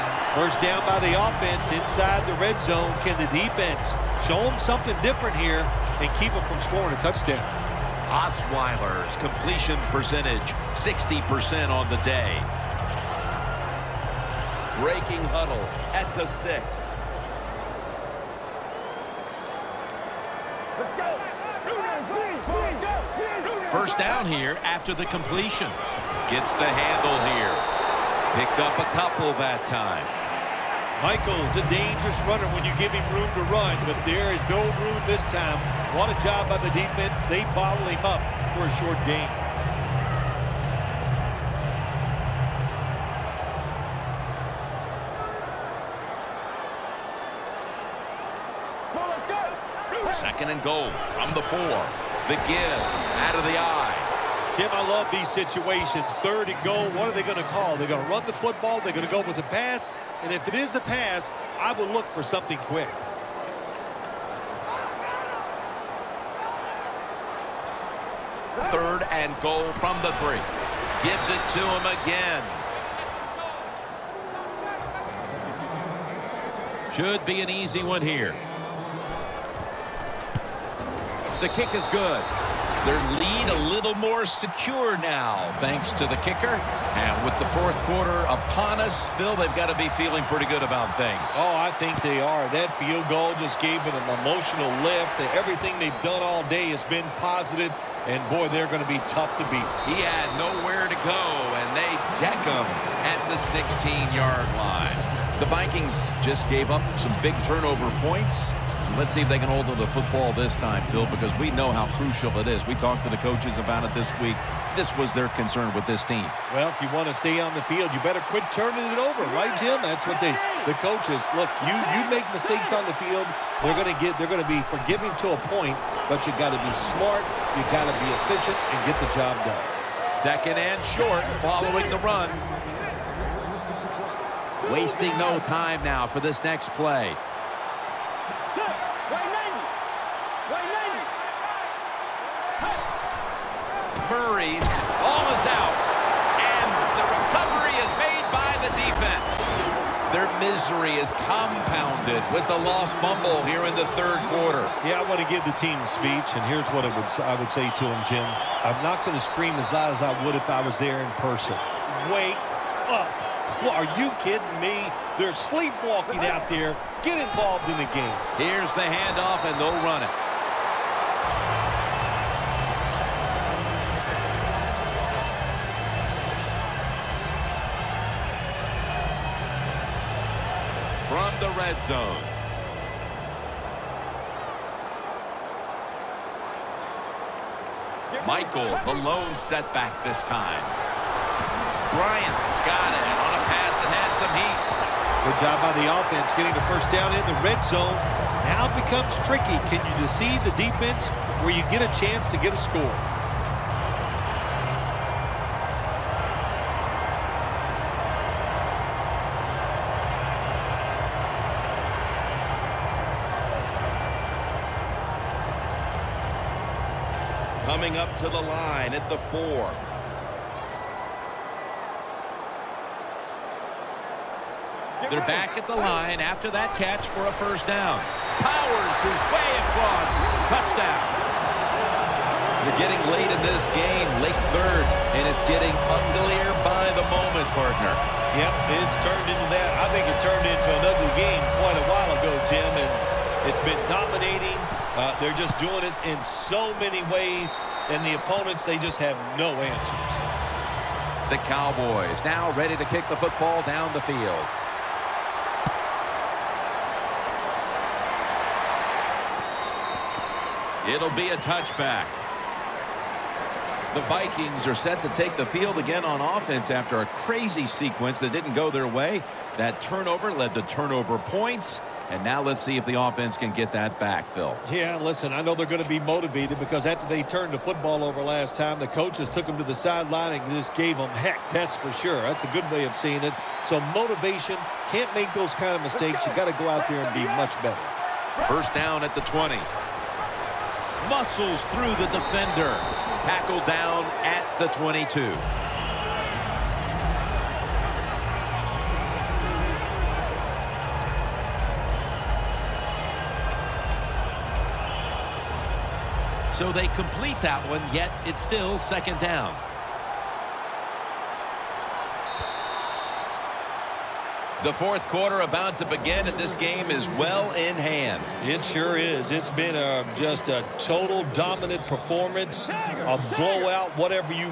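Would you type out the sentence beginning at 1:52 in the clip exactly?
We talked to the coaches about it this week.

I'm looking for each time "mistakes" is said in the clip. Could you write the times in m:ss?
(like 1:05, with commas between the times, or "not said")
2:02, 4:45.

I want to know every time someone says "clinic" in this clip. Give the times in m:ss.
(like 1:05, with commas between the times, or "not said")
not said.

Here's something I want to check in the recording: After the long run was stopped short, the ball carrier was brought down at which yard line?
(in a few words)
16.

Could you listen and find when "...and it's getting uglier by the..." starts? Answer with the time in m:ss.
3:55.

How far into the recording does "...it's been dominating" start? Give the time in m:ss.
4:03.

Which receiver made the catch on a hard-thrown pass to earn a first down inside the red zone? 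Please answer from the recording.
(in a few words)
Bryant.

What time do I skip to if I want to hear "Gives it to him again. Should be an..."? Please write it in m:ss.
1:11.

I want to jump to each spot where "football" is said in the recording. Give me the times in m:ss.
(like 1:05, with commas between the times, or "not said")
0:58, 1:49, 4:13, 4:37.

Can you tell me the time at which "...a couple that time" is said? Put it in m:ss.
0:28.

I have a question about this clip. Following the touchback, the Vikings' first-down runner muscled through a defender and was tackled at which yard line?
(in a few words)
22.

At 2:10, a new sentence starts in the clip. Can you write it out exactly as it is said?
Second and short following the run.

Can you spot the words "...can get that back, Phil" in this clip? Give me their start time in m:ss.
4:33.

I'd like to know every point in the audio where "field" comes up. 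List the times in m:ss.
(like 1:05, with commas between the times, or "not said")
1:32, 1:57, 2:03, 4:14, 4:25.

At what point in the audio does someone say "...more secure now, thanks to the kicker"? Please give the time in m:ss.
1:23.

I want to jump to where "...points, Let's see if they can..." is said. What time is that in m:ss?
1:47.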